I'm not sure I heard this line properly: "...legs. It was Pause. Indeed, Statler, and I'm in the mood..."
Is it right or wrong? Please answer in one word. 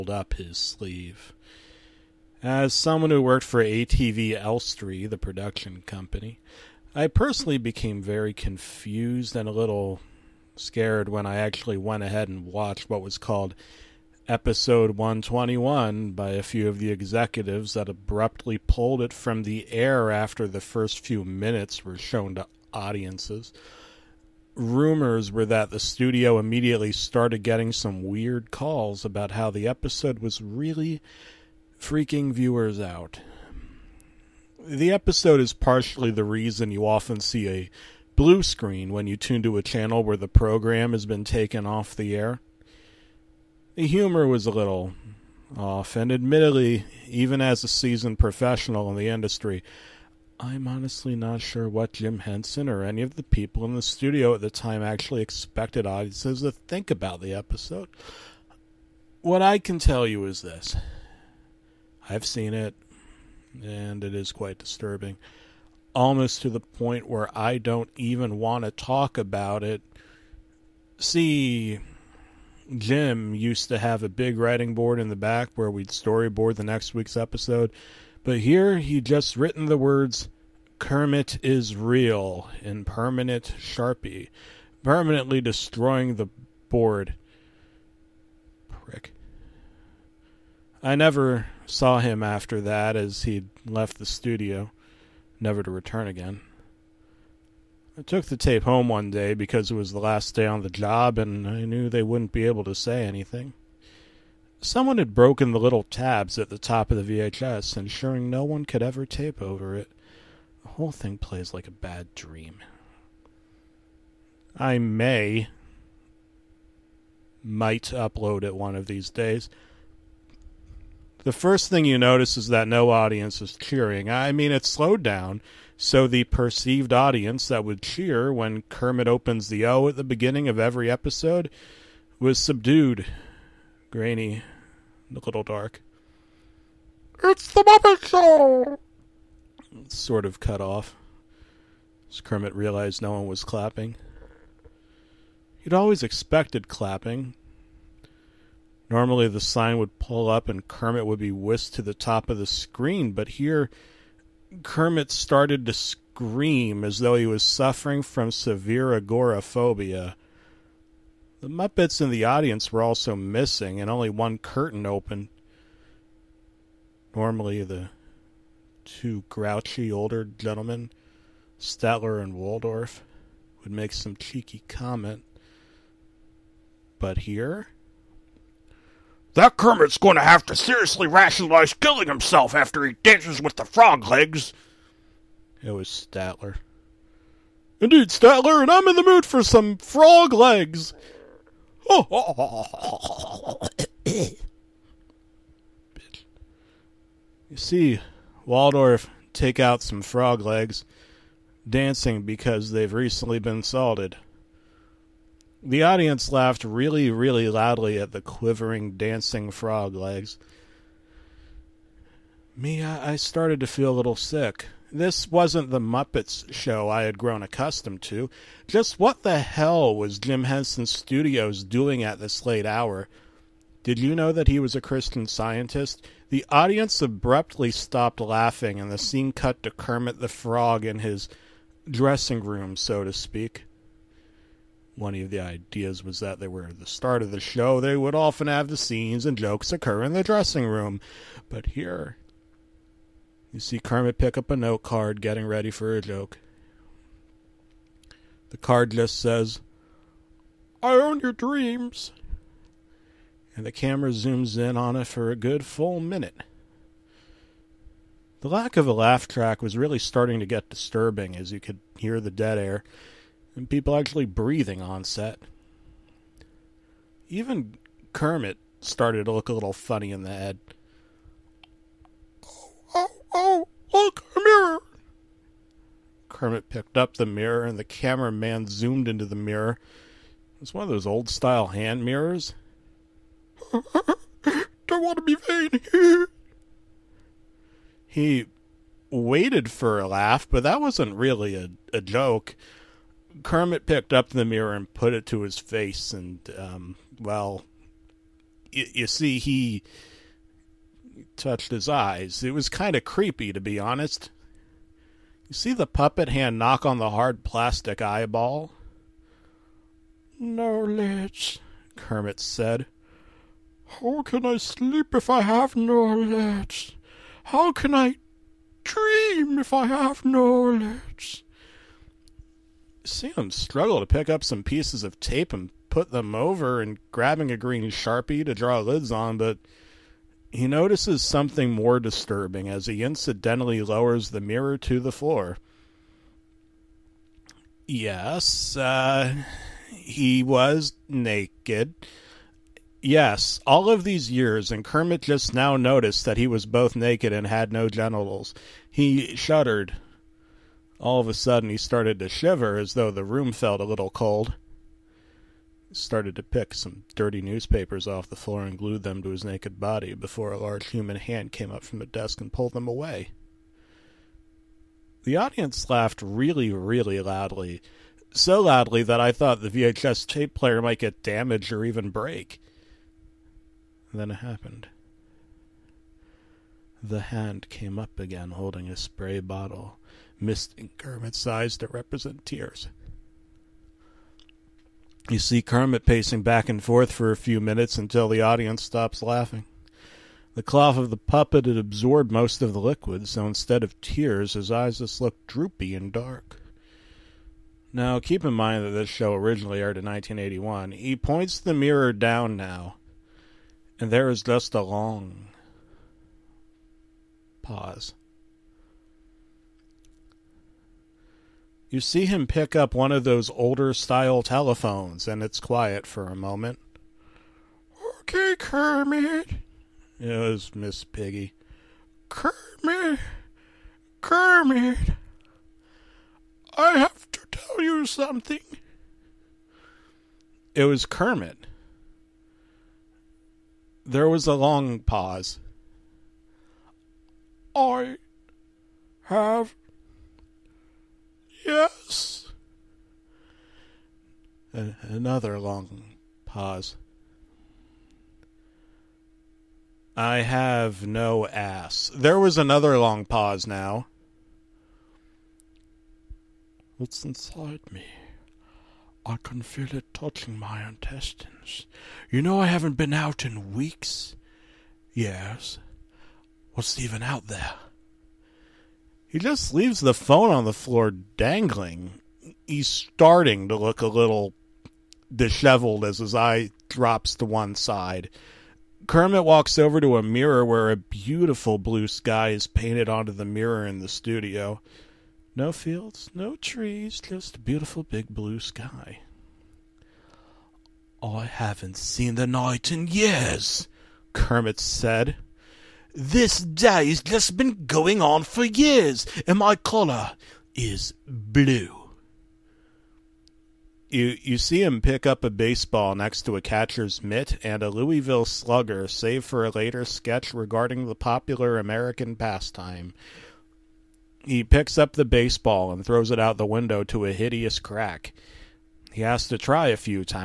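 wrong.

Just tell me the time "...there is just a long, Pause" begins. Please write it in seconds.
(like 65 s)
404 s.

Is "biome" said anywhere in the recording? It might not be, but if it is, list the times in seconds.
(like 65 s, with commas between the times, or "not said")
not said.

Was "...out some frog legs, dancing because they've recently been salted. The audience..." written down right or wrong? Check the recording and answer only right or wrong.
right.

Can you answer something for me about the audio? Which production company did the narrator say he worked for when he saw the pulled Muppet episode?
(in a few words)
ATV Elstree.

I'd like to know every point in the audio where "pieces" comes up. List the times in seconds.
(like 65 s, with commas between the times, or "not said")
324 s.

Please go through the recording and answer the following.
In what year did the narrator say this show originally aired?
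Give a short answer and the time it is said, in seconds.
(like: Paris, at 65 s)
1981, at 400 s.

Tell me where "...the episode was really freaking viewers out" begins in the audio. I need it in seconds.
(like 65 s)
29 s.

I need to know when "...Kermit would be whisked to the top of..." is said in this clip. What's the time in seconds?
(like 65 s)
150 s.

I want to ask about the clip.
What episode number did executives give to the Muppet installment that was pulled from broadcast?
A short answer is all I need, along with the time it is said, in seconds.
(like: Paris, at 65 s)
121, at 14 s.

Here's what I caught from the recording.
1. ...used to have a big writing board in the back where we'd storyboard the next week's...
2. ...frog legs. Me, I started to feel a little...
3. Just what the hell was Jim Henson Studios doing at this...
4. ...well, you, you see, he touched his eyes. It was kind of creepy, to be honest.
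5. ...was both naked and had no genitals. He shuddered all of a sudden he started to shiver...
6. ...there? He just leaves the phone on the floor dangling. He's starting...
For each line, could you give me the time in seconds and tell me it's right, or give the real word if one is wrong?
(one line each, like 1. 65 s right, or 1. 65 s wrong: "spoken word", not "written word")
1. 73 s right
2. 209 s right
3. 218 s right
4. 297 s right
5. 346 s right
6. 467 s right.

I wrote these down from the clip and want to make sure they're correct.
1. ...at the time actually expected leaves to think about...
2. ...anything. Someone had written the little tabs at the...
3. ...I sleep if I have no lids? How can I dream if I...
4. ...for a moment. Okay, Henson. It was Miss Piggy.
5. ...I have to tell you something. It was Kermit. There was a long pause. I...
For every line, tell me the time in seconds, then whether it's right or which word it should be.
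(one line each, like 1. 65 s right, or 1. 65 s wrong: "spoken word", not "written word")
1. 54 s wrong: "audiences", not "leaves"
2. 103 s wrong: "broken", not "written"
3. 314 s right
4. 416 s wrong: "Kermit", not "Henson"
5. 426 s right.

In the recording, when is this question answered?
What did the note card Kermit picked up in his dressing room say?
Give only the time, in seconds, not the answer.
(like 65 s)
250 s.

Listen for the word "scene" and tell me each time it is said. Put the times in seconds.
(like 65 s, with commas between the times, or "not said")
228 s, 238 s.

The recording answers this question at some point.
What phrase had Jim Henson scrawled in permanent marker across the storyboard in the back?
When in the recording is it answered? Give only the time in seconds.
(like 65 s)
80 s.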